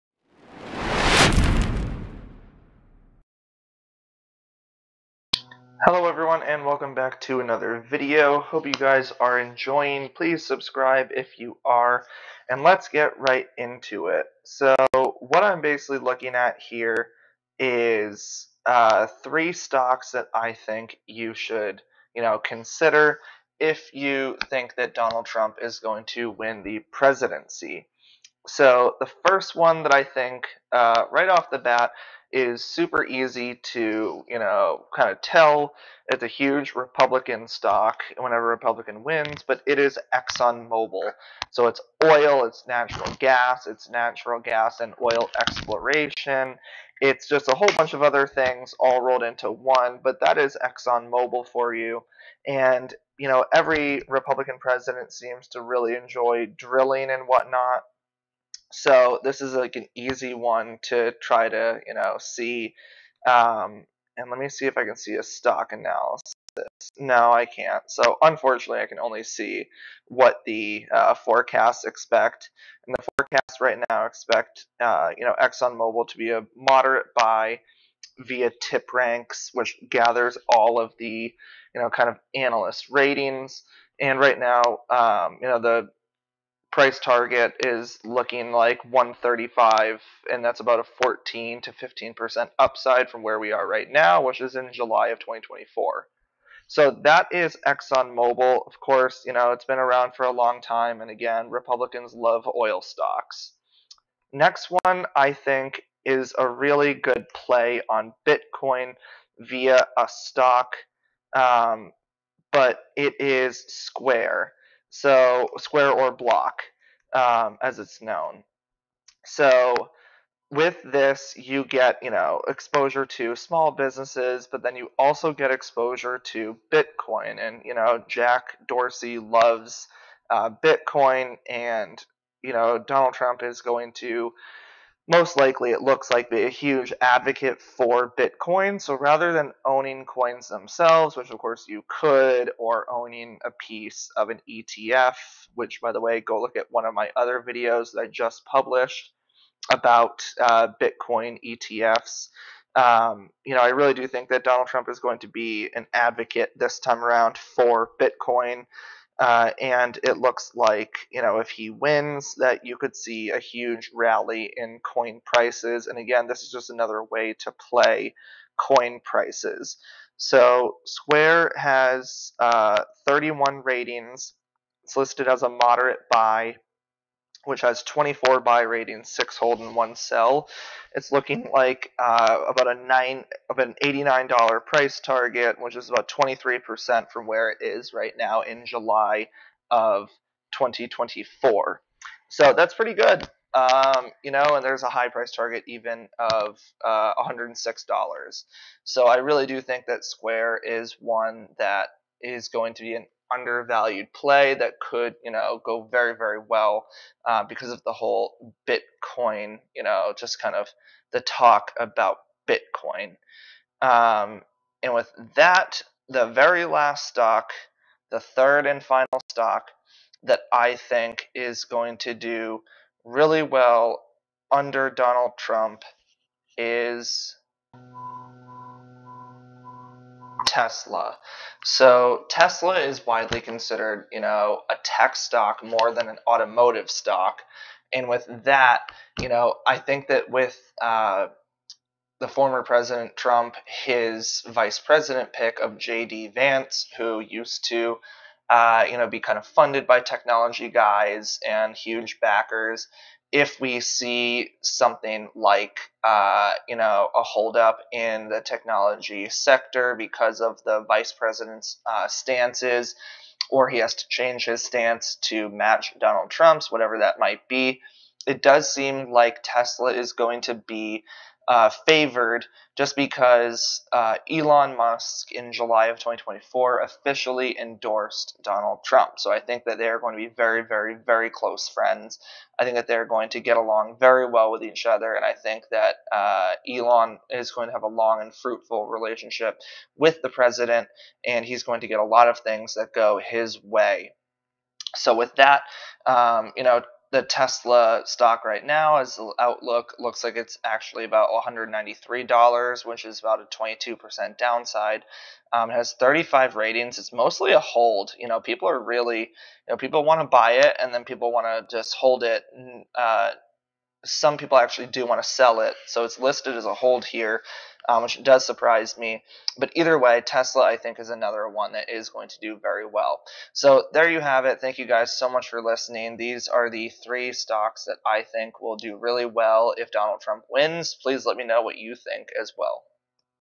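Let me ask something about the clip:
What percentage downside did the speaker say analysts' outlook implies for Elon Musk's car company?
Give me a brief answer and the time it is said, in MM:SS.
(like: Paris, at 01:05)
22%, at 05:03.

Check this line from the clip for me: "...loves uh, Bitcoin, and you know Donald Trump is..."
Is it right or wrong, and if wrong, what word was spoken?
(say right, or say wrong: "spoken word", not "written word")
right.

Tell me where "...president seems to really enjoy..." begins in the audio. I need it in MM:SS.
00:54.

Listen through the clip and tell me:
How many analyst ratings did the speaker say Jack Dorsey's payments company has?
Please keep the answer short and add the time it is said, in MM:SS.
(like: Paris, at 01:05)
31, at 02:53.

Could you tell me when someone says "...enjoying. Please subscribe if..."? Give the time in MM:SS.
00:09.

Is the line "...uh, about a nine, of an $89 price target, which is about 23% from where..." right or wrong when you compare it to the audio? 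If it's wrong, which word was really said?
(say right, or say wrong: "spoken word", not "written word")
right.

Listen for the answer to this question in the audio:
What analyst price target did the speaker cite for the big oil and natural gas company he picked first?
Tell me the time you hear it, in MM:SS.
01:28.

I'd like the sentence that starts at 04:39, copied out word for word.
So I think that they are going to be very, very, very close friends.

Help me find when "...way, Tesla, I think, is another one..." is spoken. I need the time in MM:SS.
05:19.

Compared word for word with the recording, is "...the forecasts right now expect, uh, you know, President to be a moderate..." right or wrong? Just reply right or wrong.
wrong.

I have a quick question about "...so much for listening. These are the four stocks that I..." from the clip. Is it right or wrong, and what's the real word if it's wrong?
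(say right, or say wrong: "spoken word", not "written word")
wrong: "three", not "four".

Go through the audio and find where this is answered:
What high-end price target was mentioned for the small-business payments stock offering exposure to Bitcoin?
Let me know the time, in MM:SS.
03:17.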